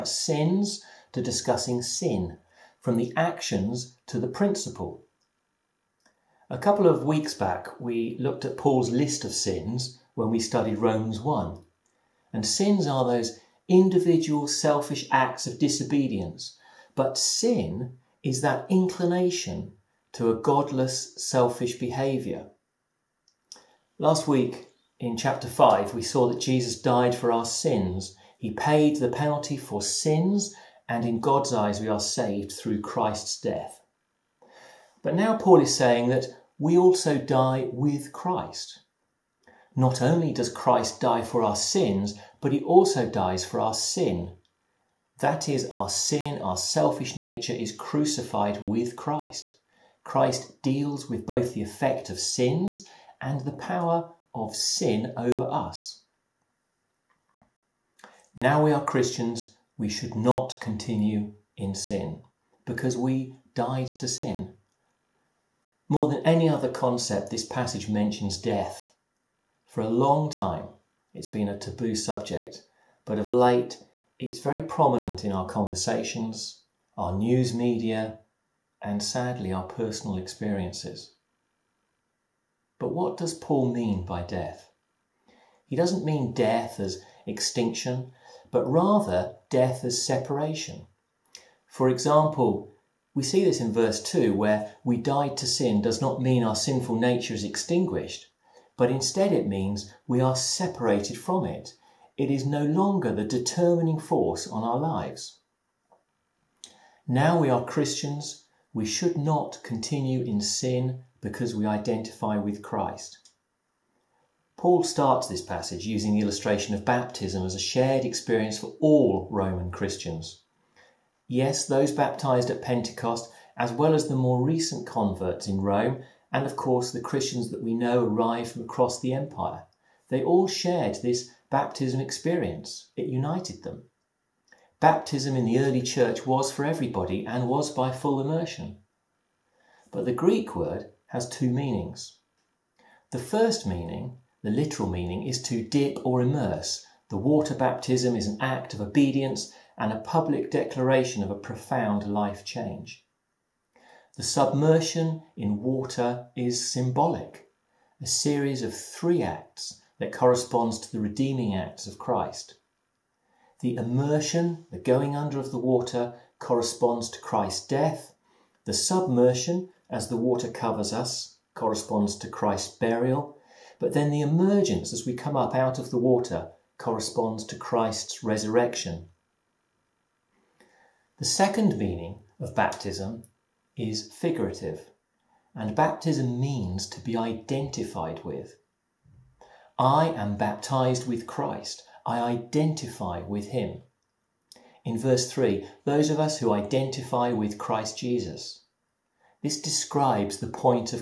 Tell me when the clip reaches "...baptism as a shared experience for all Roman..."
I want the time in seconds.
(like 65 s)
116 s.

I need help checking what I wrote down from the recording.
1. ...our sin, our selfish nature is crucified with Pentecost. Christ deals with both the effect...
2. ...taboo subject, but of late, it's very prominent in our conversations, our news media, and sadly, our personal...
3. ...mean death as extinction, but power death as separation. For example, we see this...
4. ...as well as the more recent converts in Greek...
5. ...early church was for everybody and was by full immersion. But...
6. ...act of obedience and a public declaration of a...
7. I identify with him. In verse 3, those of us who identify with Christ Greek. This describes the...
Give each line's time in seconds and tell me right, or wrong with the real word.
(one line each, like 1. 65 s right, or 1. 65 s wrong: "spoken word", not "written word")
1. 45 s wrong: "Christ", not "Pentecost"
2. 71 s right
3. 86 s wrong: "rather", not "power"
4. 123 s wrong: "Rome", not "Greek"
5. 135 s right
6. 148 s right
7. 192 s wrong: "Jesus", not "Greek".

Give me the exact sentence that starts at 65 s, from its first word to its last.
More than any other concept, this passage mentions death.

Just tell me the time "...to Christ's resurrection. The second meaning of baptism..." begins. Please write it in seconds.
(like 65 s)
177 s.